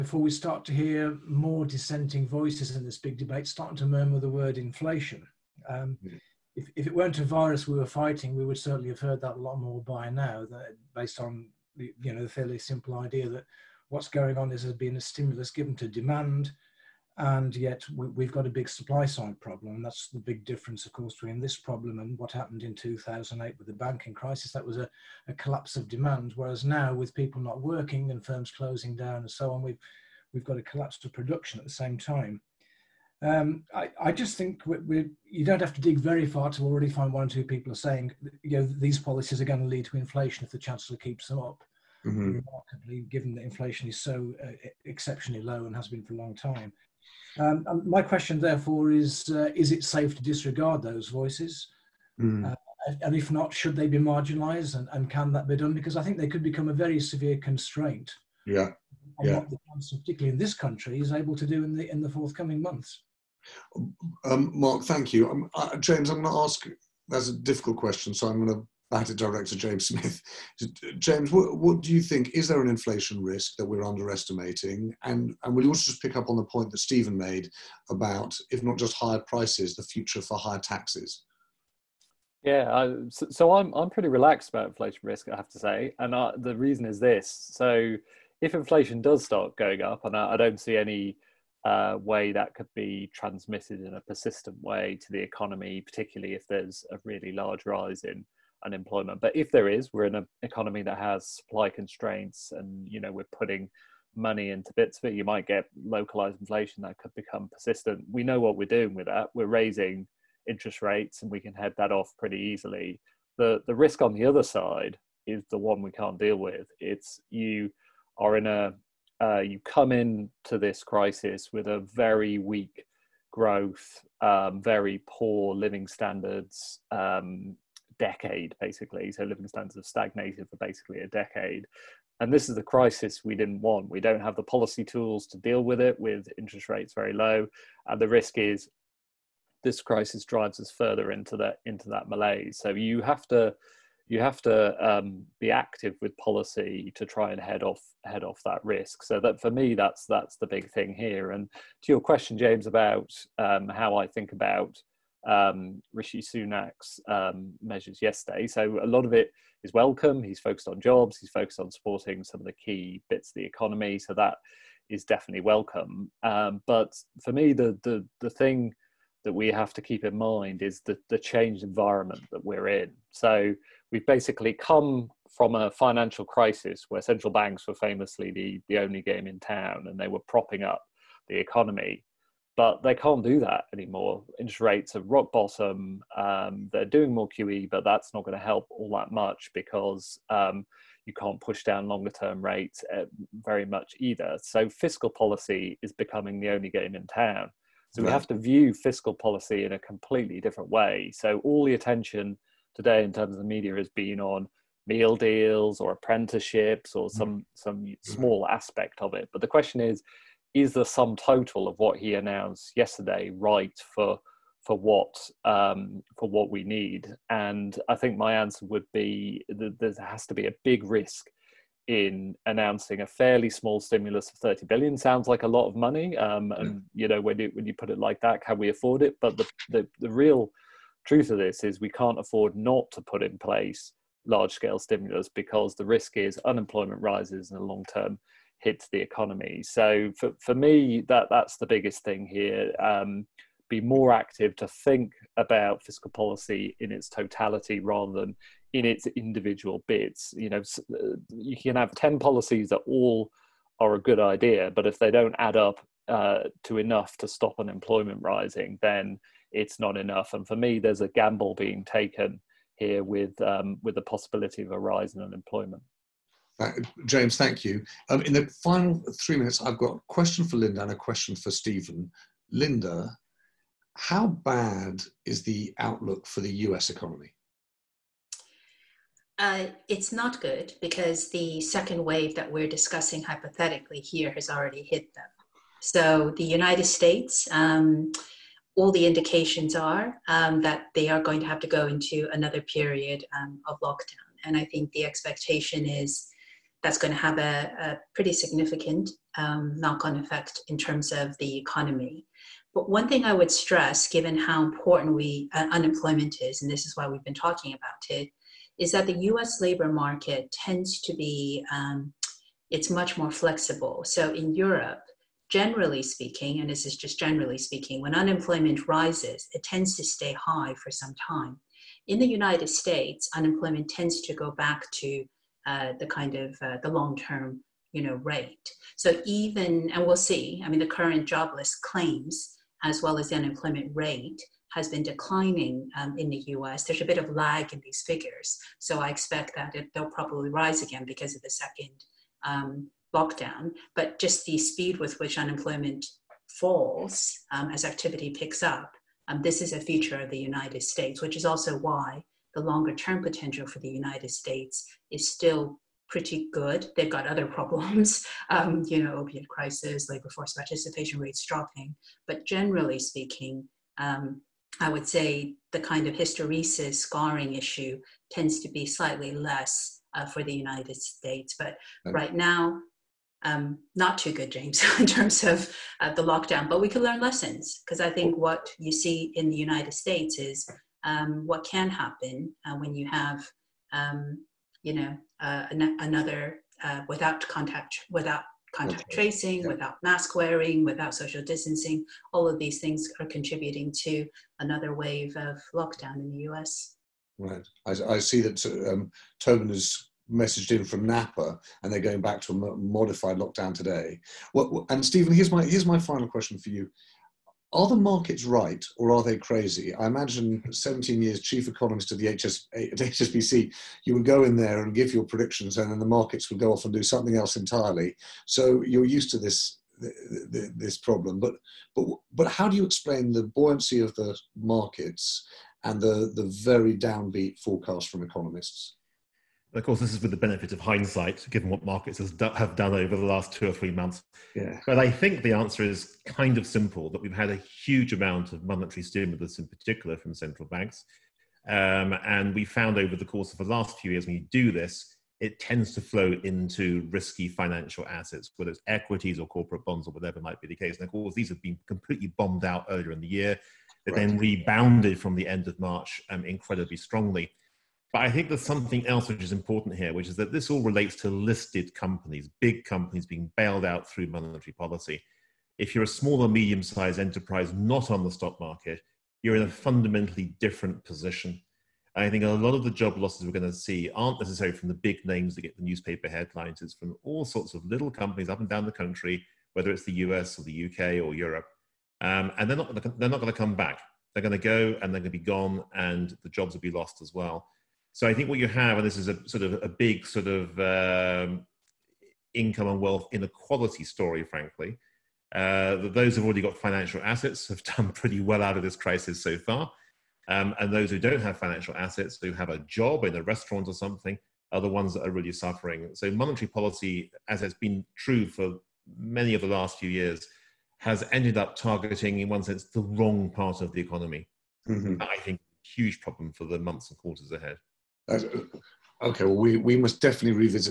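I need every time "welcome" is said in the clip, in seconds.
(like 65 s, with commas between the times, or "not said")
159 s, 165 s.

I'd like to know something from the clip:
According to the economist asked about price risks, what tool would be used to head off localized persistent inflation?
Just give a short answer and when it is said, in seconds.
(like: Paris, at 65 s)
Raising interest rates, at 109 s.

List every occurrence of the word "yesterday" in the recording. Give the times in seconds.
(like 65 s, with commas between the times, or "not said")
158 s, 212 s.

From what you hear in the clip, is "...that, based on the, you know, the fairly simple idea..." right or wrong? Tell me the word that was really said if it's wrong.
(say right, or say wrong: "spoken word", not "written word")
right.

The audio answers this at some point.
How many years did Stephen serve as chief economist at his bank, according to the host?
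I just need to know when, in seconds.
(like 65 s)
410 s.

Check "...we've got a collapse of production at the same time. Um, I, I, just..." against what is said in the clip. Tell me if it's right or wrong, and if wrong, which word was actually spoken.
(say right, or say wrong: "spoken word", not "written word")
right.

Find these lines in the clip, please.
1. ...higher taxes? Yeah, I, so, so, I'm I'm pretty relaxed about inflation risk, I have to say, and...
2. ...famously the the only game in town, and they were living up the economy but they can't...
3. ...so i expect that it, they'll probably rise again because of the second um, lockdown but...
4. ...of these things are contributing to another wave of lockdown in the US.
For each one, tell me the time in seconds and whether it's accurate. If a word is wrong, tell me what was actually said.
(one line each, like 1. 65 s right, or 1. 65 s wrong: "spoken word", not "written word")
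1. 80 s right
2. 177 s wrong: "propping", not "living"
3. 338 s right
4. 392 s right.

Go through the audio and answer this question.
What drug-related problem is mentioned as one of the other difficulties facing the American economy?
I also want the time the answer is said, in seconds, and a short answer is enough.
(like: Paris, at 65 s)
Opiate crisis, at 359 s.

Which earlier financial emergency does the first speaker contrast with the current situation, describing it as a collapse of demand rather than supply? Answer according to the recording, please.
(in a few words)
2008 banking crisis.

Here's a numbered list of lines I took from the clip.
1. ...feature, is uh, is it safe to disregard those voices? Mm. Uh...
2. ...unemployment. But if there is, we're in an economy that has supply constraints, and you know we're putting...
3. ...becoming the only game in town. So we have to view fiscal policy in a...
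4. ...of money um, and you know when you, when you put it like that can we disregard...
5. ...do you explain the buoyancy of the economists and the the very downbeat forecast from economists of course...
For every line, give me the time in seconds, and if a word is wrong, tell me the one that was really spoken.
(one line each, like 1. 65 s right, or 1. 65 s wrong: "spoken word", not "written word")
1. 48 s wrong: "therefore", not "feature"
2. 98 s right
3. 195 s right
4. 225 s wrong: "afford", not "disregard"
5. 422 s wrong: "markets", not "economists".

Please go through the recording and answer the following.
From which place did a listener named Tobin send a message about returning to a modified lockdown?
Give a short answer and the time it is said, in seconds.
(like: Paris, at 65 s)
Napa, at 401 s.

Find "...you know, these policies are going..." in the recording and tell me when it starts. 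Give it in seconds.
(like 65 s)
38 s.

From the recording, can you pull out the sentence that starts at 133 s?
We don't have the policy tools to deal with it with interest rates very low.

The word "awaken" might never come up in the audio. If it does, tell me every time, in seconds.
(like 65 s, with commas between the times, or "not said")
not said.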